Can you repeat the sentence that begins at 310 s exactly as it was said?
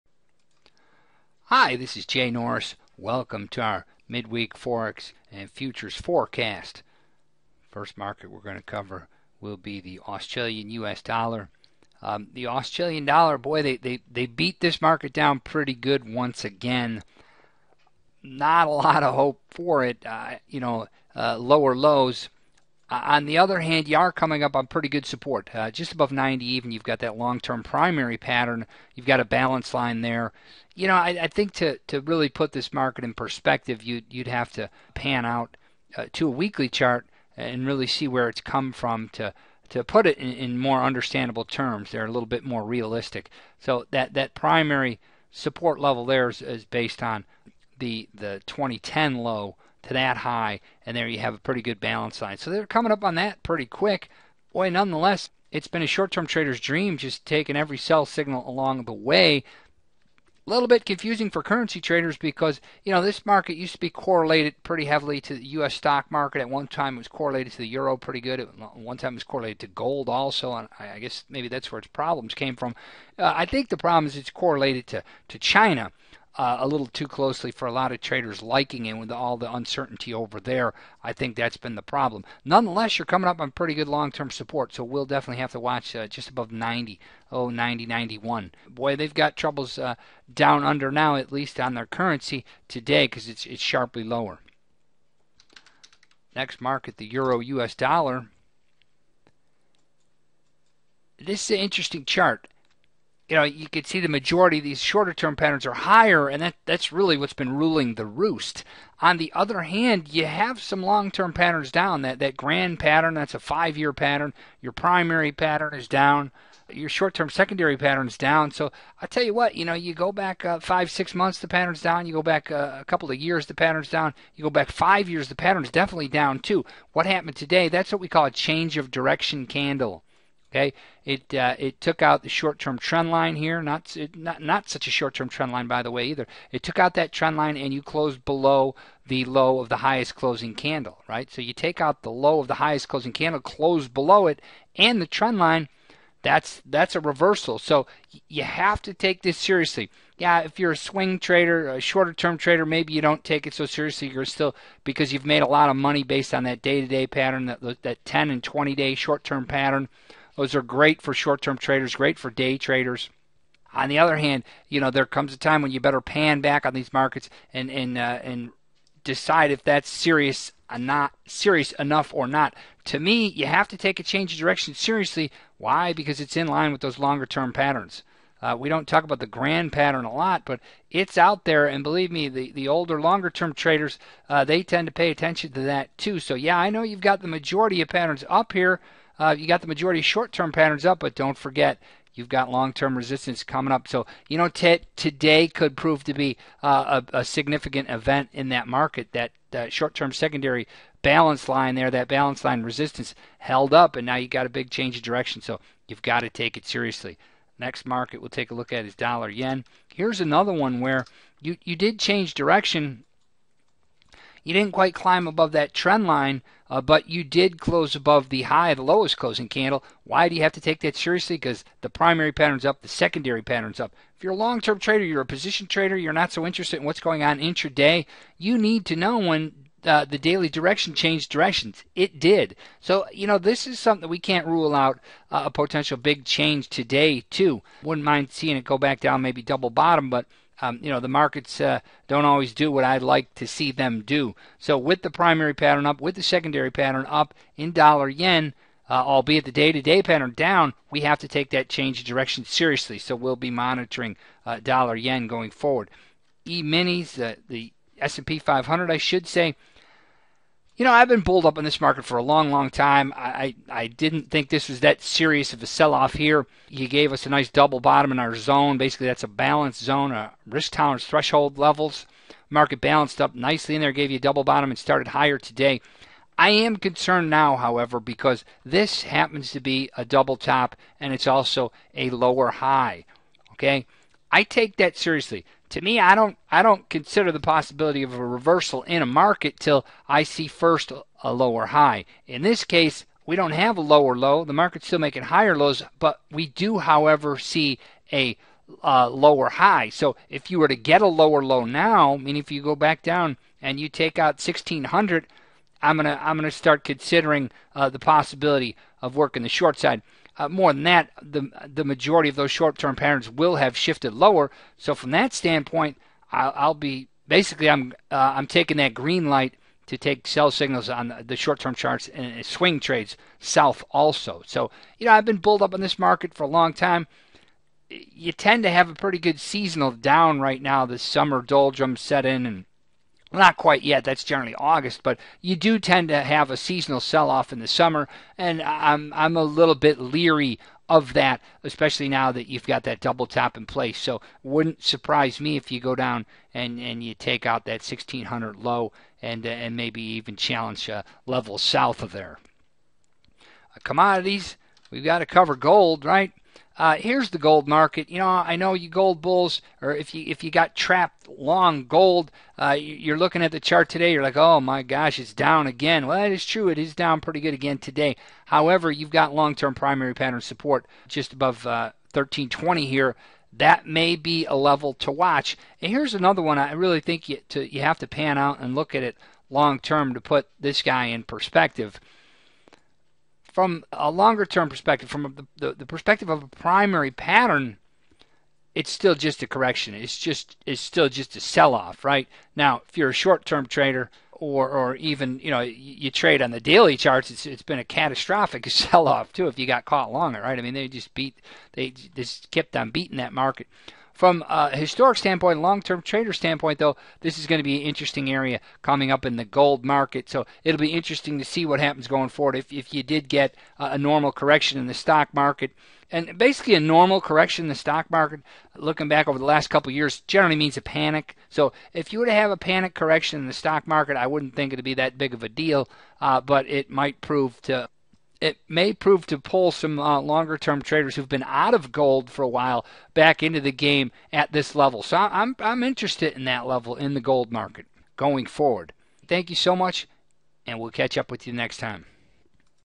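Uh, more than that, the the majority of those short-term patterns will have shifted lower.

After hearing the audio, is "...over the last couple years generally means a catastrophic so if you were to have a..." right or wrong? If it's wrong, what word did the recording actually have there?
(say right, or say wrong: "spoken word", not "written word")
wrong: "panic", not "catastrophic".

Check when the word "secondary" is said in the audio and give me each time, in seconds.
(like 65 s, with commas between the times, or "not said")
117 s, 200 s, 222 s, 246 s.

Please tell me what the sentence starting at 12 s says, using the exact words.
Um, the Australian dollar, boy, they, they, they beat this market down pretty good once again.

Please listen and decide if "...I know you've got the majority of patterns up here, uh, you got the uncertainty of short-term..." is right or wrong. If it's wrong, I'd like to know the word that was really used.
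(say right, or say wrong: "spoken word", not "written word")
wrong: "majority", not "uncertainty".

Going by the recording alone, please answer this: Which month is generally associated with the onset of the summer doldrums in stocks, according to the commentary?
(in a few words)
August.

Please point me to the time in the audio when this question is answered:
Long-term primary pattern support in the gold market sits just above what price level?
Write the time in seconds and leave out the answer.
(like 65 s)
372 s.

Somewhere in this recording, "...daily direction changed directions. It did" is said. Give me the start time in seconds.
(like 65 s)
230 s.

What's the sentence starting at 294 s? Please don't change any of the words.
The market's still making higher lows, but we do, however, see a uh, lower high.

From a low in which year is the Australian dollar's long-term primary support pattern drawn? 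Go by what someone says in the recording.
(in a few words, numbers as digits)
2010.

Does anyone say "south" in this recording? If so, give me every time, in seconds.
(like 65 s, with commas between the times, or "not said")
323 s, 351 s.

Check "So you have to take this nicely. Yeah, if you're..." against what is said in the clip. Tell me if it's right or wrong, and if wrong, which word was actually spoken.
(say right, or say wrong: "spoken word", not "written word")
wrong: "seriously", not "nicely".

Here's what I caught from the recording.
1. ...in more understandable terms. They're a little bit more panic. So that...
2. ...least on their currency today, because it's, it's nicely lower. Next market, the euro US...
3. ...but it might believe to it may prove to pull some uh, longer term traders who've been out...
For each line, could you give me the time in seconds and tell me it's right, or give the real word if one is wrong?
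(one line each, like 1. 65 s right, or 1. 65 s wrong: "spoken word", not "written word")
1. 40 s wrong: "realistic", not "panic"
2. 91 s wrong: "sharply", not "nicely"
3. 426 s wrong: "prove", not "believe".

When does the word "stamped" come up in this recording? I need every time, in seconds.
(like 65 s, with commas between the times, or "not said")
not said.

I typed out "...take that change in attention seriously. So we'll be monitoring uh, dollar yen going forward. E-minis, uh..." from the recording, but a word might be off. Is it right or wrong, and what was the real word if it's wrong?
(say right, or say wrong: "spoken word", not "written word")
wrong: "direction", not "attention".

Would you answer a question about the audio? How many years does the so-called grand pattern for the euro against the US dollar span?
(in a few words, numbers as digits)
5 years.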